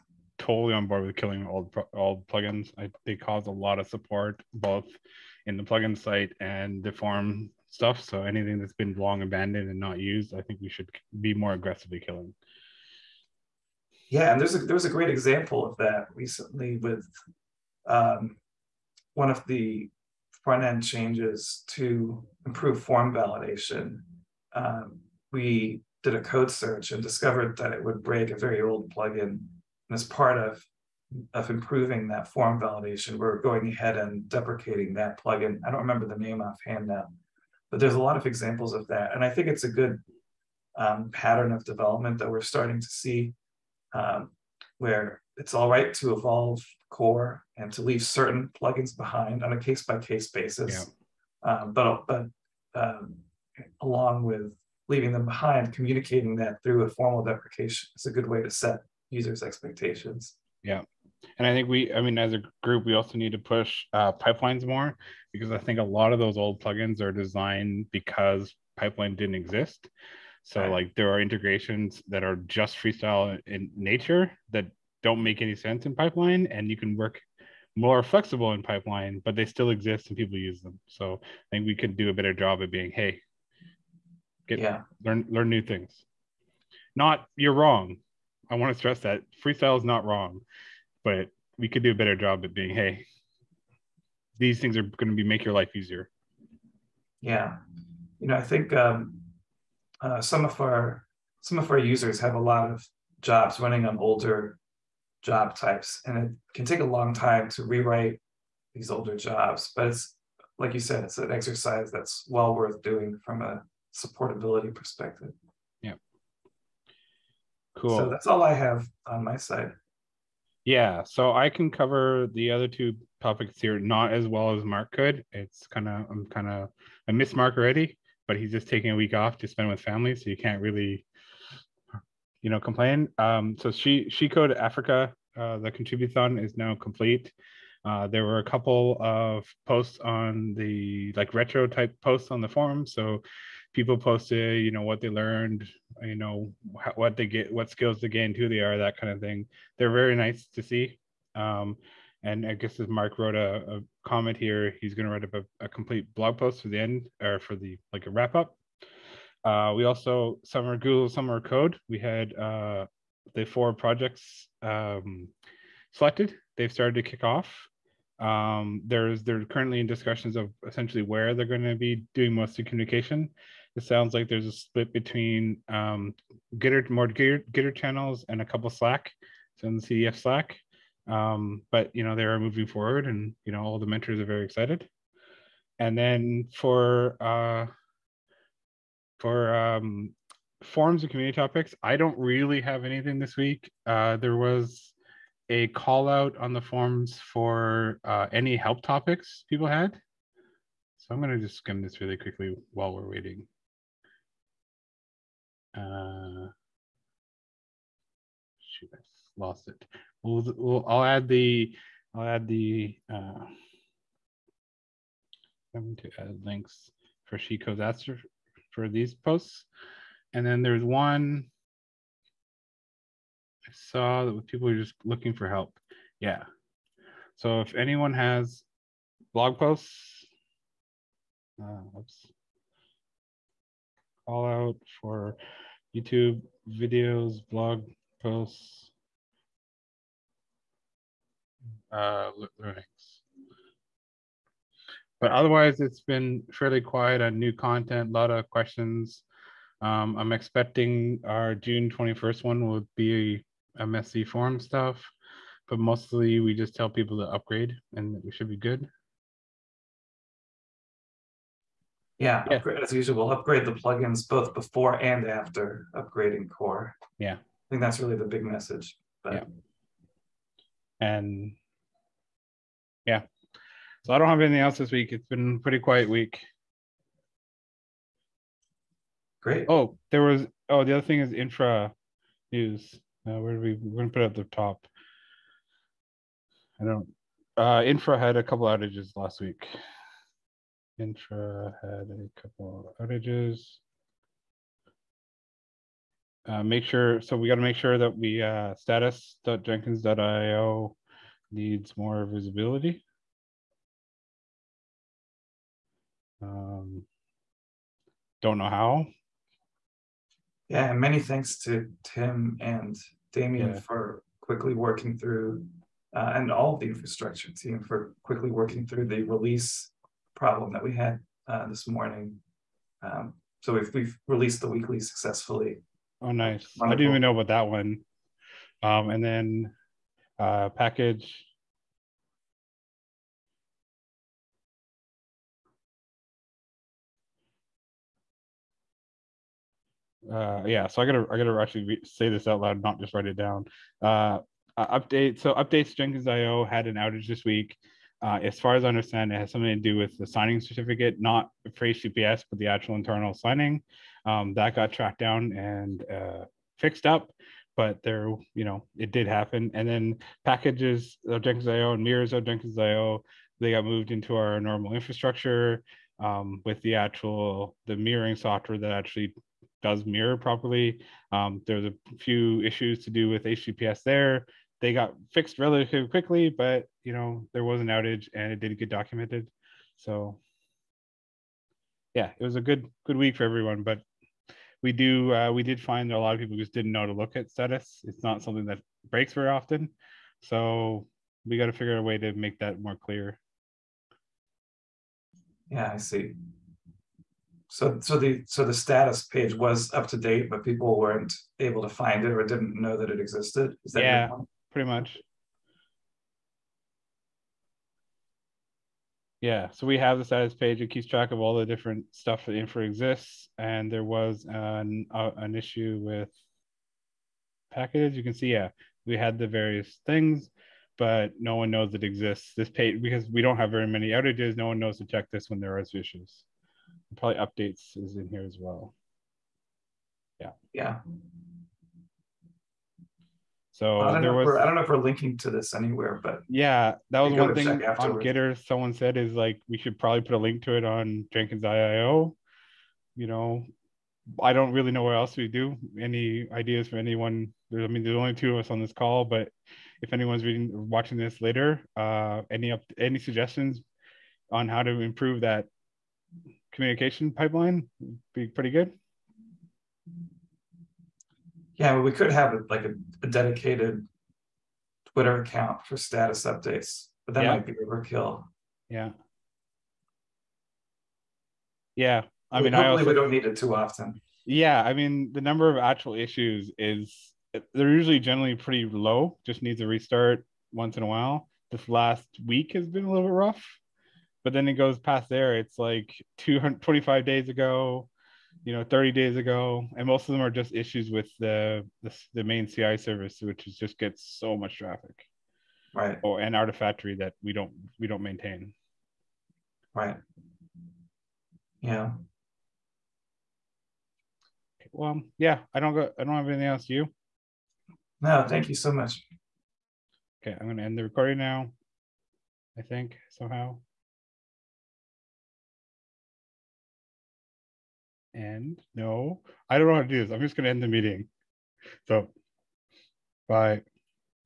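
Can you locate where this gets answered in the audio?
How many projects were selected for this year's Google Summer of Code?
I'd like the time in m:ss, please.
2:43.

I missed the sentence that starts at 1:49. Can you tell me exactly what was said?
But it's like you said, it's an exercise that's well worth doing from a supportability perspective.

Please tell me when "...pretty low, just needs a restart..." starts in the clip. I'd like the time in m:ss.
7:58.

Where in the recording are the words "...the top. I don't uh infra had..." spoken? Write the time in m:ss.
4:44.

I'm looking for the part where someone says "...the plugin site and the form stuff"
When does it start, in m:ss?
0:05.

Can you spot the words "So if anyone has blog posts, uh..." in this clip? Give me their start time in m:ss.
3:47.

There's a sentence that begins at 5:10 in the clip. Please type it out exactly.
Yeah, and many thanks to Tim and Damien yeah.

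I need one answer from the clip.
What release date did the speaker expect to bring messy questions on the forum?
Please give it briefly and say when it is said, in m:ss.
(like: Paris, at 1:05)
June 21st, at 4:11.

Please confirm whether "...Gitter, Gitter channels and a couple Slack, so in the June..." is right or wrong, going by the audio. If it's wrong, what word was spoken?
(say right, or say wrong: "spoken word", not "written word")
wrong: "CDF", not "June".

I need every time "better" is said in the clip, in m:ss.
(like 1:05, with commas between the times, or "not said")
1:22, 1:31.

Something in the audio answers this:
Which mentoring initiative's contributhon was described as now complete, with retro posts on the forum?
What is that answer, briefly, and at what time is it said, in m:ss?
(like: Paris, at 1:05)
She Code Africa, at 2:13.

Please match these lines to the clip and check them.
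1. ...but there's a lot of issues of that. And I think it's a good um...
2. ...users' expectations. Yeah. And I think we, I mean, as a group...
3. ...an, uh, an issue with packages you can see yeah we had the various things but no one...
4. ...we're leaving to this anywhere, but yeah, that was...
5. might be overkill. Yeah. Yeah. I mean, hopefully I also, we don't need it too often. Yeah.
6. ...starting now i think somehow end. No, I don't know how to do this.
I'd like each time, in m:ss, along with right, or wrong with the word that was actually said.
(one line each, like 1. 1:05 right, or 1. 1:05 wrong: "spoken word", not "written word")
1. 0:37 wrong: "examples", not "issues"
2. 0:59 right
3. 6:54 right
4. 7:14 wrong: "linking", not "leaving"
5. 7:47 right
6. 8:31 wrong: "recording", not "starting".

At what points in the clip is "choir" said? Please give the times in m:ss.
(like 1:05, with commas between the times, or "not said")
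not said.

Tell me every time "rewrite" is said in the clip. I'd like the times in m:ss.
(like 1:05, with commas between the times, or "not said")
1:47.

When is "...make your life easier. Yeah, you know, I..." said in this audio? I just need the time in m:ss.
1:35.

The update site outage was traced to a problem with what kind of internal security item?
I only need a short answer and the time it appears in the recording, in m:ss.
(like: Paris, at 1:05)
signing certificate, at 5:50.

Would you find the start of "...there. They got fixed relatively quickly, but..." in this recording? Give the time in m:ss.
6:14.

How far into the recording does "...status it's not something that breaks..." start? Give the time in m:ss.
6:27.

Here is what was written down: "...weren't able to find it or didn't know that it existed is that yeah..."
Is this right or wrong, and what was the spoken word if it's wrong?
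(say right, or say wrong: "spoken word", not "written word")
right.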